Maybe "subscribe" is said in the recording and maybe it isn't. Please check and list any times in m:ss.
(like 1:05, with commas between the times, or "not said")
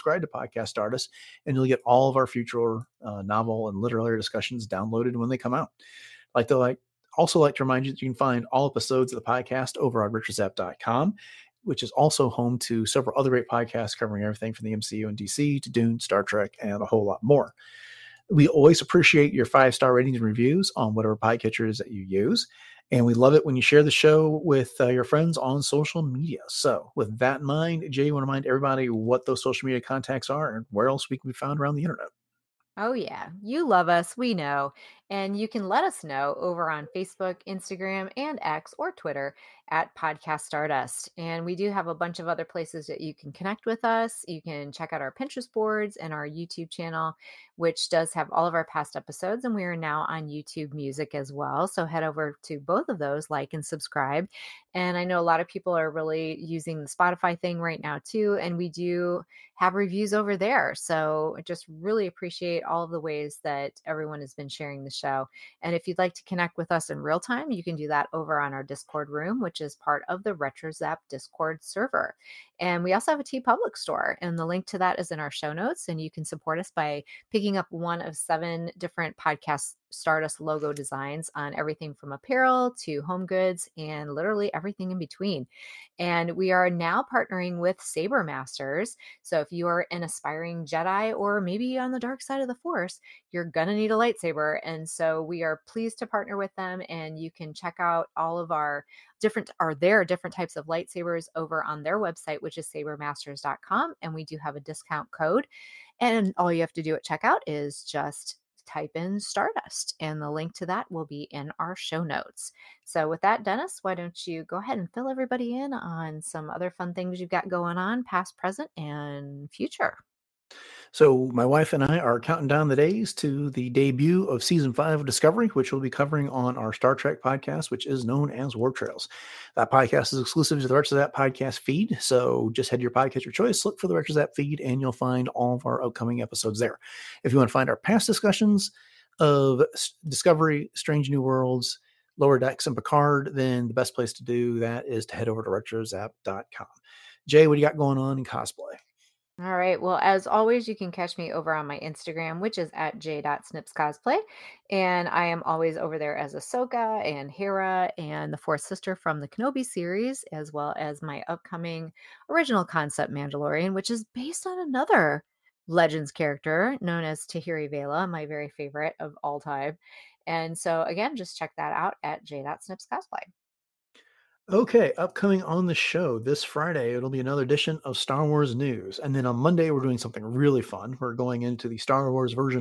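0:53.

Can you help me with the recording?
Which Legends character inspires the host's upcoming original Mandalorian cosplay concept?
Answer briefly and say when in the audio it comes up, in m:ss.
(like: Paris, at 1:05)
Tahiri Veila, at 2:47.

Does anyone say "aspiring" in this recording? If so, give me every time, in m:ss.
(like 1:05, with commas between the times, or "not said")
1:30.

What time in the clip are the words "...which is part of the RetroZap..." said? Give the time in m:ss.
1:09.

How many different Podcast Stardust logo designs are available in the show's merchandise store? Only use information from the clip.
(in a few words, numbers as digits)
7.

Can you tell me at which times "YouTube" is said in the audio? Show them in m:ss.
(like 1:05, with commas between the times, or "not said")
0:46, 0:50.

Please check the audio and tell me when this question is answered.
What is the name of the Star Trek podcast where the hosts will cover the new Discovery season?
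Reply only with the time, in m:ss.
2:08.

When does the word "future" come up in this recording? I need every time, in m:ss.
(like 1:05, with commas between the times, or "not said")
0:02, 1:59.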